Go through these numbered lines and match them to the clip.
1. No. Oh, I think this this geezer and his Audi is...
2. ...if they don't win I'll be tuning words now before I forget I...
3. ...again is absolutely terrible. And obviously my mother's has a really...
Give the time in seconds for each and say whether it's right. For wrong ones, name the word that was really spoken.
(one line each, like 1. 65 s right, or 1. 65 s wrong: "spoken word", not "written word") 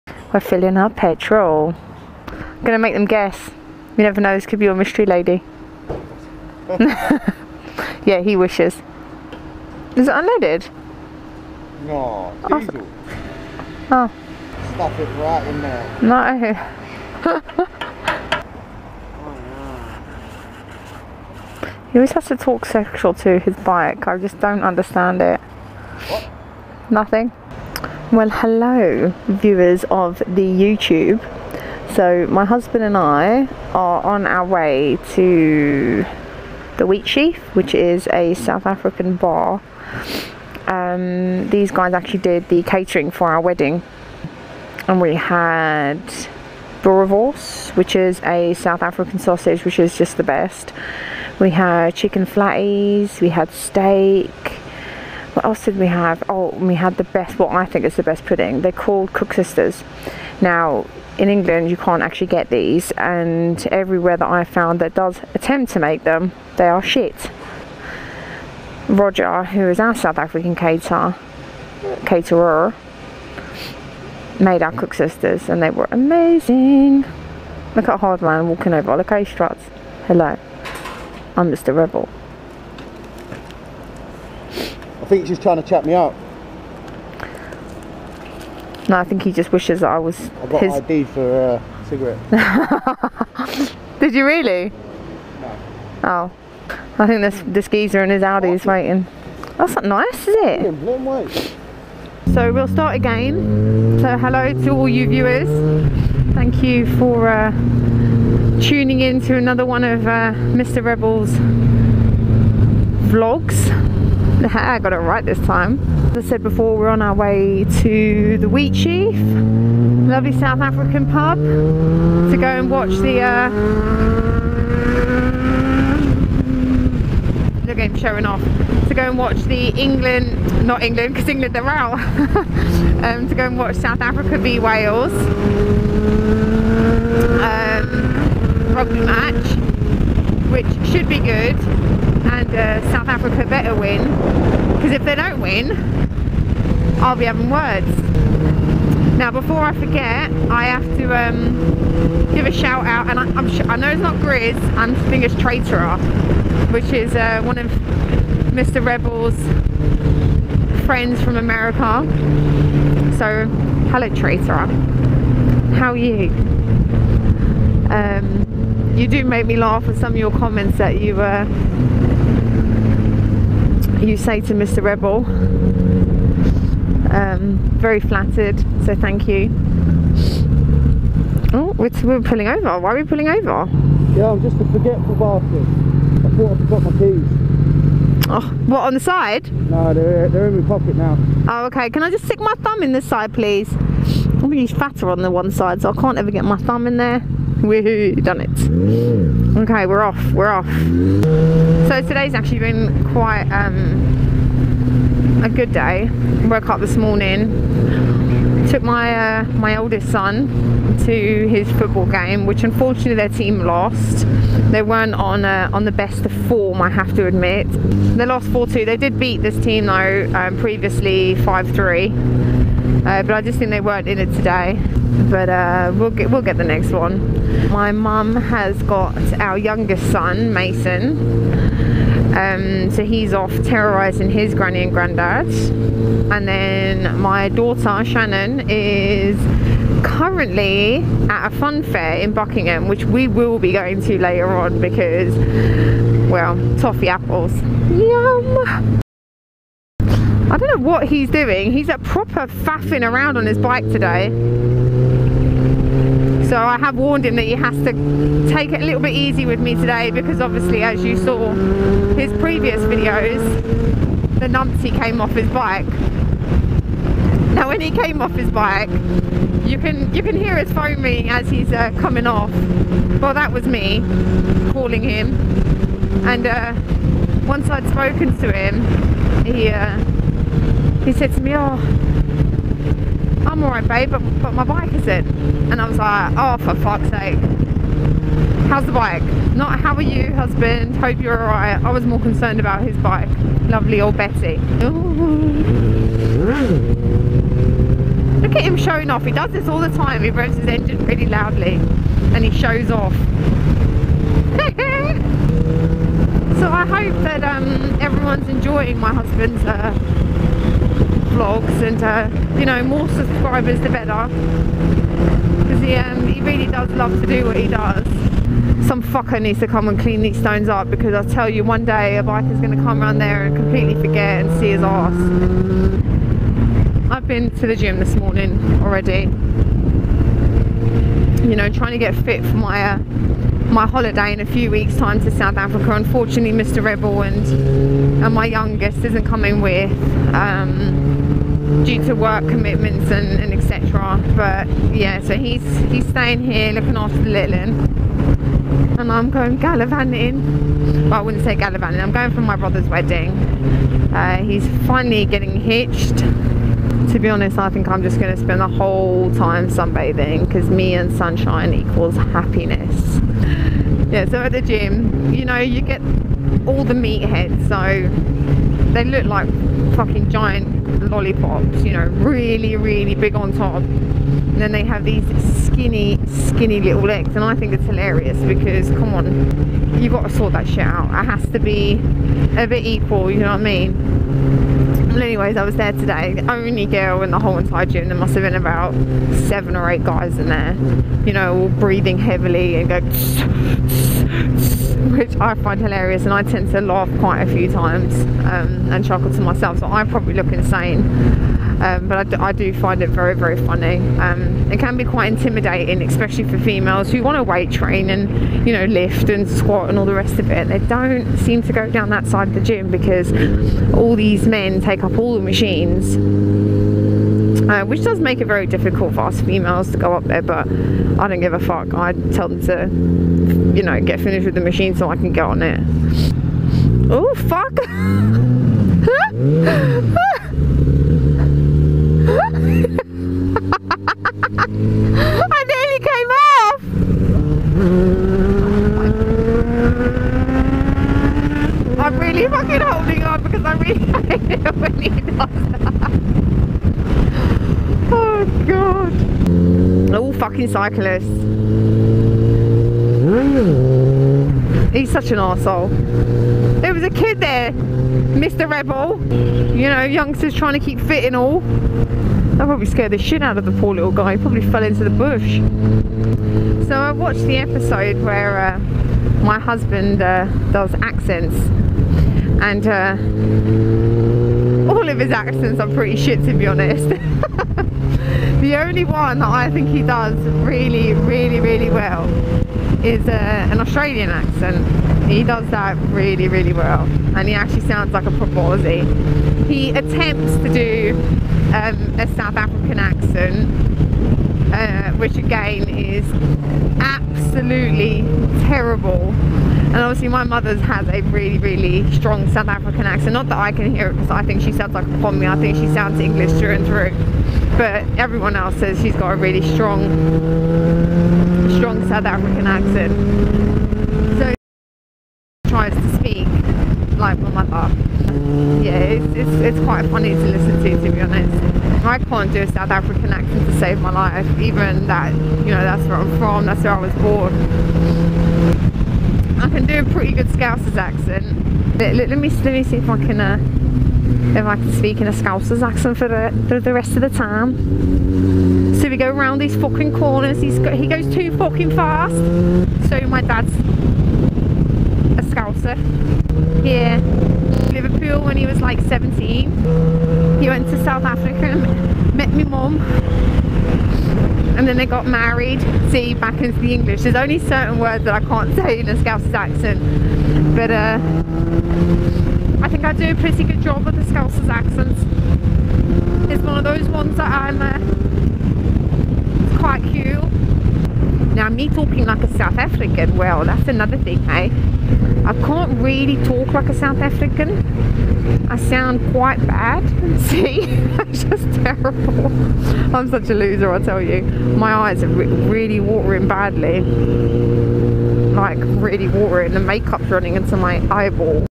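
1. 96 s right
2. 144 s wrong: "having", not "tuning"
3. 495 s right.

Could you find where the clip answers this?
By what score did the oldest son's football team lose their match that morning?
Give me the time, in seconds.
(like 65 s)
218 s.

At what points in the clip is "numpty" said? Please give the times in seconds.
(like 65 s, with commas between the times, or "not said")
264 s.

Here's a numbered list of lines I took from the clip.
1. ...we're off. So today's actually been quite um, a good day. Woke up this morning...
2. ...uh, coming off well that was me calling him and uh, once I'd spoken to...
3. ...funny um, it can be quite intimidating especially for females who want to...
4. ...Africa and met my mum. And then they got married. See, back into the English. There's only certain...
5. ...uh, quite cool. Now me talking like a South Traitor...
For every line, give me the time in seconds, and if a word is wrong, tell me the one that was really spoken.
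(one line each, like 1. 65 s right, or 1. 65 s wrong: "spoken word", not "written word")
1. 200 s right
2. 271 s right
3. 403 s right
4. 551 s right
5. 567 s wrong: "African", not "Traitor".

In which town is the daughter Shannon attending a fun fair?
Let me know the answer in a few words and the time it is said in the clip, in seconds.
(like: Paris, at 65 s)
Buckingham, at 242 s.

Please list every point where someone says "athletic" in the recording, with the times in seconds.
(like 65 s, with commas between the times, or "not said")
not said.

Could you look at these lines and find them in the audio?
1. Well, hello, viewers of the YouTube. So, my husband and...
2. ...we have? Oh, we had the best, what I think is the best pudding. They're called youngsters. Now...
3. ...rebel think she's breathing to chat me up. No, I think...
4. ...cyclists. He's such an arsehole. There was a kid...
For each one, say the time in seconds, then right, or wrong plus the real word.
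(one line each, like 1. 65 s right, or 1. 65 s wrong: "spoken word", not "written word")
1. 28 s right
2. 55 s wrong: "koeksisters", not "youngsters"
3. 81 s wrong: "trying", not "breathing"
4. 450 s right.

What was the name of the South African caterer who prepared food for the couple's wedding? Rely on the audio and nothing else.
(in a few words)
Roger.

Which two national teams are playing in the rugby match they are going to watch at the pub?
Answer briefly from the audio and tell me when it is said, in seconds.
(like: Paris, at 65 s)
South Africa v Wales, at 133 s.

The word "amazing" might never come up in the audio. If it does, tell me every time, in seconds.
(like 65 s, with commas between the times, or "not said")
75 s.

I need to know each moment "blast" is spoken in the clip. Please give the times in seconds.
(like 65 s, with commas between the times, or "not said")
not said.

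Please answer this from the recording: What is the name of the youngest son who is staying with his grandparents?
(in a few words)
Mason.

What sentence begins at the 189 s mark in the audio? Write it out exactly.
No, they're, they're in my pocket now.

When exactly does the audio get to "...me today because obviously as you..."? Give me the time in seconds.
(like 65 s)
259 s.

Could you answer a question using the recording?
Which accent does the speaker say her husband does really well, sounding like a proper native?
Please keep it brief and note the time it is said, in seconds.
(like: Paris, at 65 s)
Australian, at 483 s.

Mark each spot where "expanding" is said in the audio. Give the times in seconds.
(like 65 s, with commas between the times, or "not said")
not said.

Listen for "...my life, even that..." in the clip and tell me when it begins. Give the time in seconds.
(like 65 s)
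524 s.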